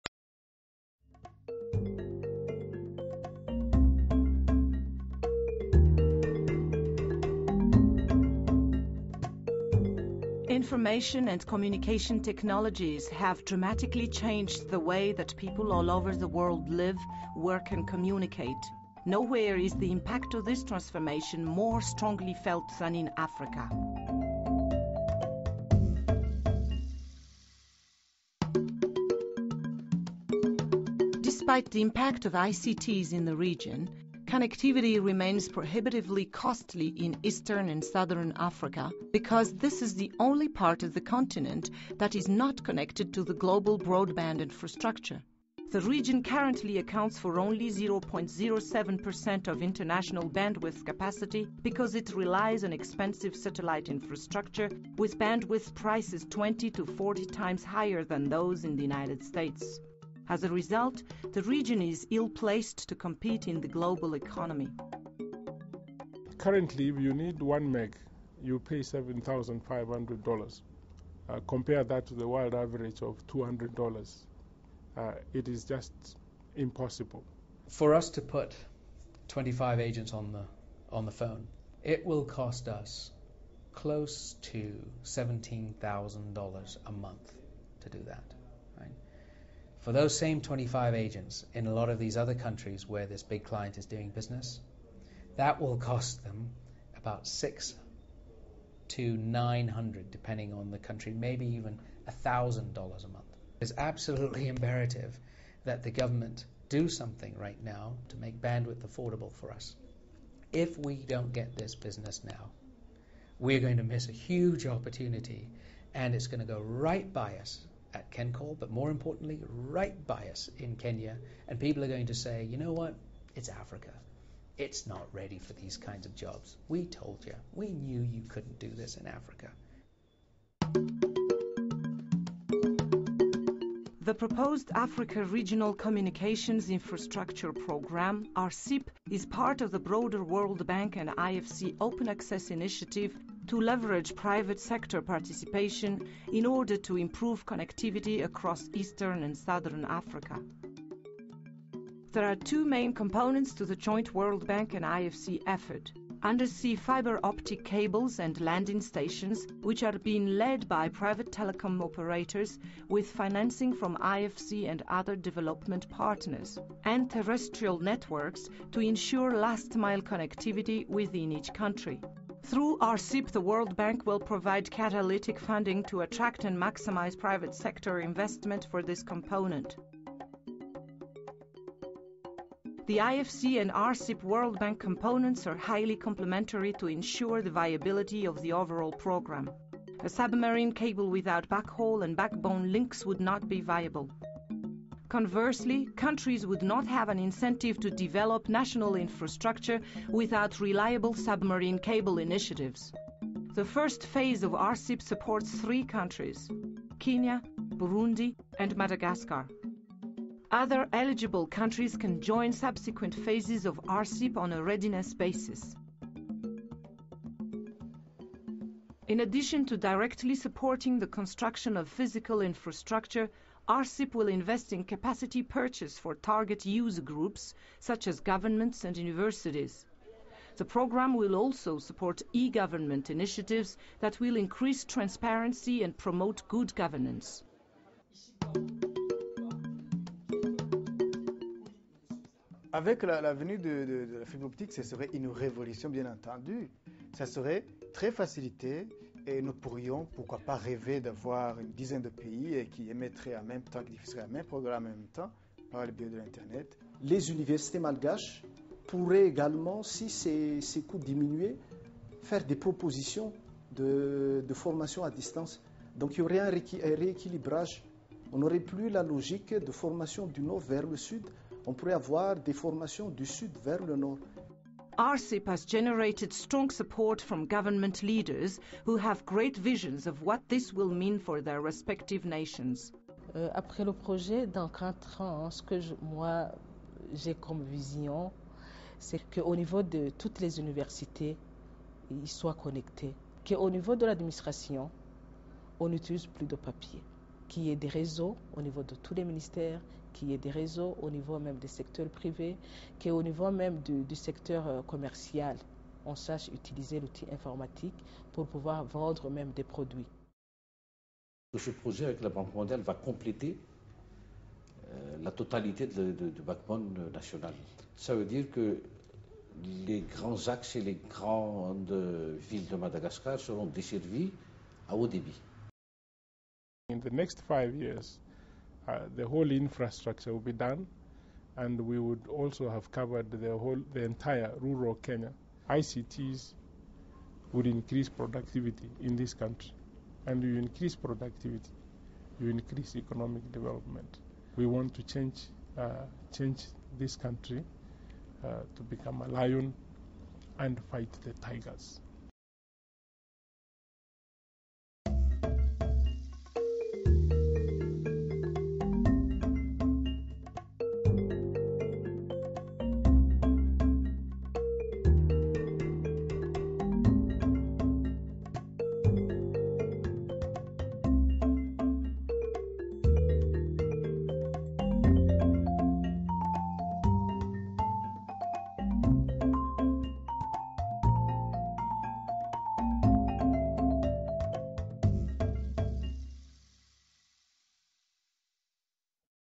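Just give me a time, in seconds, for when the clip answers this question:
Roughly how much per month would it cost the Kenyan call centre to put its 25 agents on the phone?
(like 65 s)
85 s.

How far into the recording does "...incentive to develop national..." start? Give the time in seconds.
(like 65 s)
197 s.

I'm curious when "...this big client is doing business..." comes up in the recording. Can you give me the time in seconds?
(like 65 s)
93 s.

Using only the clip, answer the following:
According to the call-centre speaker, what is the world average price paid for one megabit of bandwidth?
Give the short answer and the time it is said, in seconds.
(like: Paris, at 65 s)
$200, at 73 s.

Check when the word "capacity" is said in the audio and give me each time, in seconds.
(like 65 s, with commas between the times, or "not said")
50 s, 224 s.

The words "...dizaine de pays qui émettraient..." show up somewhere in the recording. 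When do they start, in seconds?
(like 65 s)
251 s.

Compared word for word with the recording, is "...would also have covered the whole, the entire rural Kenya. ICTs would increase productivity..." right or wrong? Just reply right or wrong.
right.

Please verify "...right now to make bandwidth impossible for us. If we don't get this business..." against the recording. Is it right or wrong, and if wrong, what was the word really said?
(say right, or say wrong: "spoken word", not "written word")
wrong: "affordable", not "impossible".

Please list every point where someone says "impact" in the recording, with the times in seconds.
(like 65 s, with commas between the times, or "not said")
19 s, 31 s.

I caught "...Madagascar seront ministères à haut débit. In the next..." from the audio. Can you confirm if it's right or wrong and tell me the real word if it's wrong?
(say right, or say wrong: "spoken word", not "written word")
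wrong: "desservies", not "ministères".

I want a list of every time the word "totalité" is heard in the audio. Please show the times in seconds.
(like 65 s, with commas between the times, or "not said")
315 s.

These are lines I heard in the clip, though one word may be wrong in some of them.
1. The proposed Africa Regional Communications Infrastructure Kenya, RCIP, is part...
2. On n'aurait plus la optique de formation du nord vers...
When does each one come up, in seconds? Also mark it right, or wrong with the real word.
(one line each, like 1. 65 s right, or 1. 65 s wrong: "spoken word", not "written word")
1. 134 s wrong: "Programme", not "Kenya"
2. 268 s wrong: "logique", not "optique".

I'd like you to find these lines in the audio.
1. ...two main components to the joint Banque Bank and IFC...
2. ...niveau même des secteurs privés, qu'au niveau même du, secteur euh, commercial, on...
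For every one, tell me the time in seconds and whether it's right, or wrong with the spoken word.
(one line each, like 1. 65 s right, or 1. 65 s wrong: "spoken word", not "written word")
1. 152 s wrong: "World", not "Banque"
2. 301 s right.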